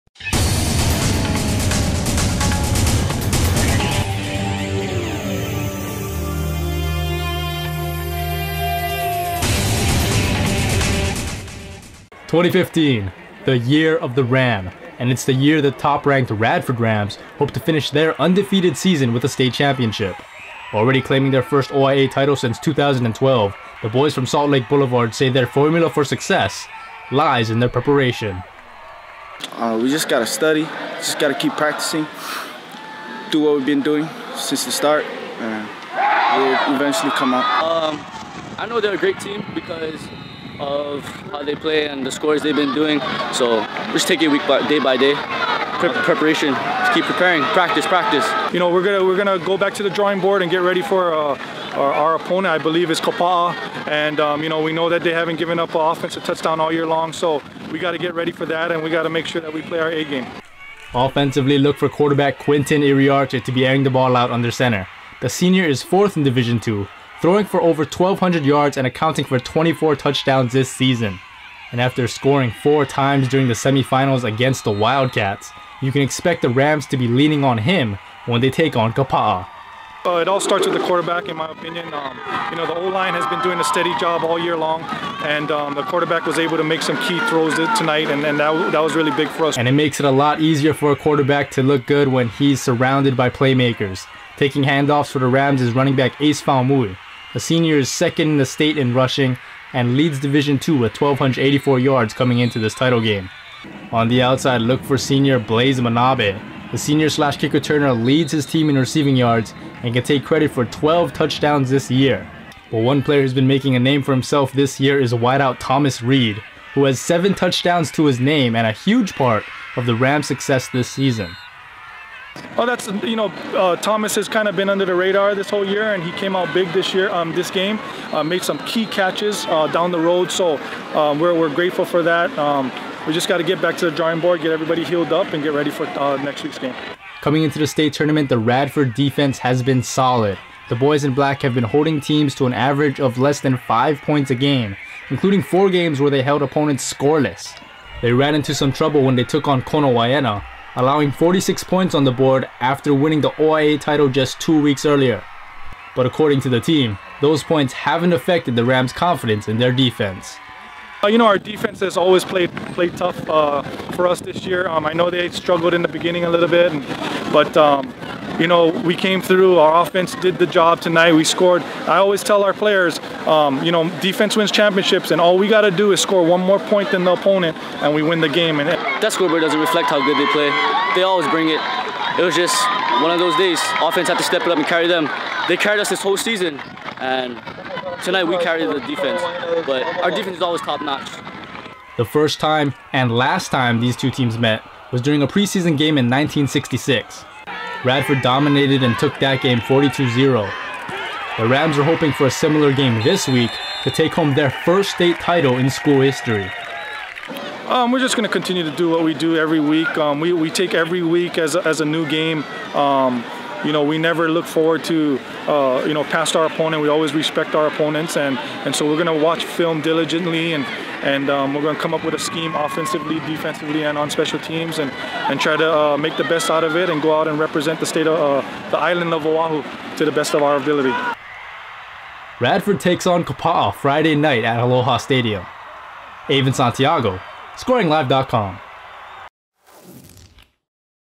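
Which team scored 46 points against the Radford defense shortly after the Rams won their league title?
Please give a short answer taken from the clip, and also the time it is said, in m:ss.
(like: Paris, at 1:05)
Konawaena, at 2:29.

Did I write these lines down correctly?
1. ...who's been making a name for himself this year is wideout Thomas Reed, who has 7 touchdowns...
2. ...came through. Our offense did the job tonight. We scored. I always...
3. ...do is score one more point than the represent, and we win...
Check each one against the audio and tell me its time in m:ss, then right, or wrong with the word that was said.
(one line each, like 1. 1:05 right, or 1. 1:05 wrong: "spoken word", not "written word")
1. 1:53 right
2. 2:48 right
3. 2:55 wrong: "opponent", not "represent".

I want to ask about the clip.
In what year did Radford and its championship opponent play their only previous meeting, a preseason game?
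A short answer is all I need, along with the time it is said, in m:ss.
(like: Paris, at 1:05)
1966, at 3:16.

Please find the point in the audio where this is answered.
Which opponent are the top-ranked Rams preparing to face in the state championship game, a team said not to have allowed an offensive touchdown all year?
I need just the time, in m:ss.
0:52.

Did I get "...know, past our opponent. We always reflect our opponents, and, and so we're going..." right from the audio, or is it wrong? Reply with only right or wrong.
wrong.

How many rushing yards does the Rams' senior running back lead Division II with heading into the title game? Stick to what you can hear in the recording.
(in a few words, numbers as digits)
1,284.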